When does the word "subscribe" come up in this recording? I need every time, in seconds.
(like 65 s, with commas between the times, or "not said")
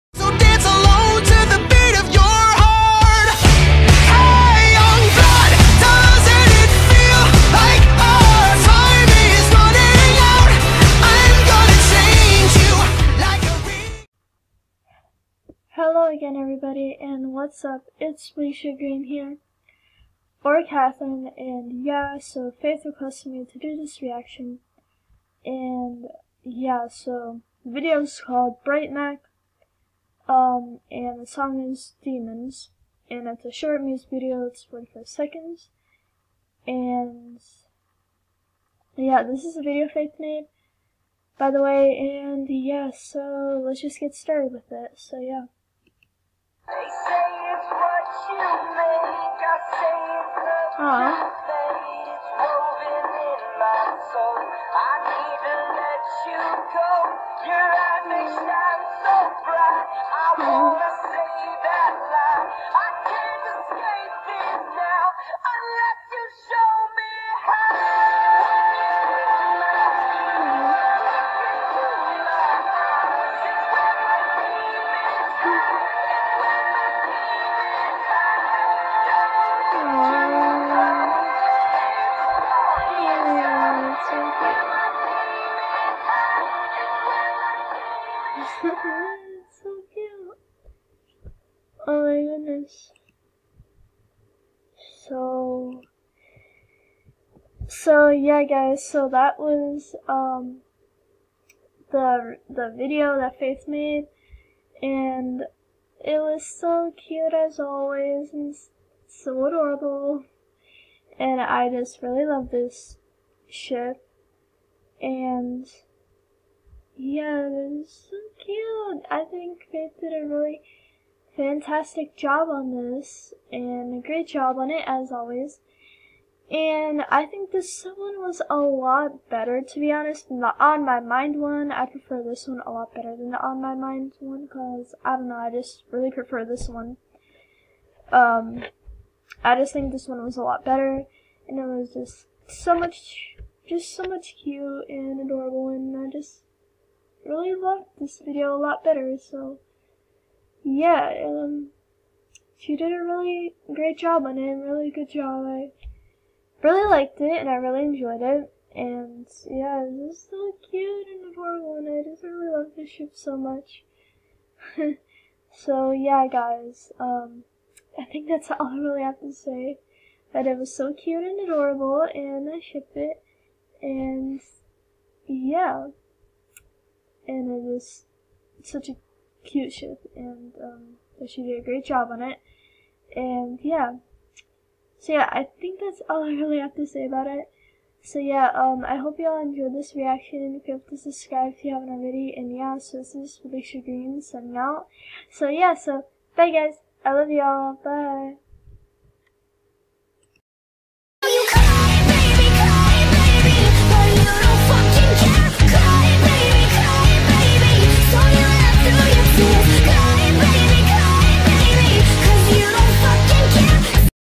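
191 s.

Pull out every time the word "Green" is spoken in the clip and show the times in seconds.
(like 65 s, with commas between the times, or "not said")
18 s, 193 s.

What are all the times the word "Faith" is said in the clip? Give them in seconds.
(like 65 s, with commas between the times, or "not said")
22 s, 39 s, 103 s.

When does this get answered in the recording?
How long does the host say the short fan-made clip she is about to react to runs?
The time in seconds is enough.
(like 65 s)
34 s.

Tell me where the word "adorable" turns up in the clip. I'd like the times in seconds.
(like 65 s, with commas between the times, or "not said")
109 s, 145 s, 161 s, 171 s.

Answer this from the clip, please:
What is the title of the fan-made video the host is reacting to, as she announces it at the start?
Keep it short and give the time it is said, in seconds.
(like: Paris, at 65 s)
Bright Mac, at 28 s.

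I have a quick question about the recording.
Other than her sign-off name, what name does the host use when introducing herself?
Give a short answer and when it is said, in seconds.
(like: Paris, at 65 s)
Catherine, at 20 s.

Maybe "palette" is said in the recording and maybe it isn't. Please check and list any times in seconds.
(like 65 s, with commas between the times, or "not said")
not said.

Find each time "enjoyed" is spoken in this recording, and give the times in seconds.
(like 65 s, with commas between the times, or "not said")
157 s, 189 s.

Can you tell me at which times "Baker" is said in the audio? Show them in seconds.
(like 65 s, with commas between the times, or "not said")
not said.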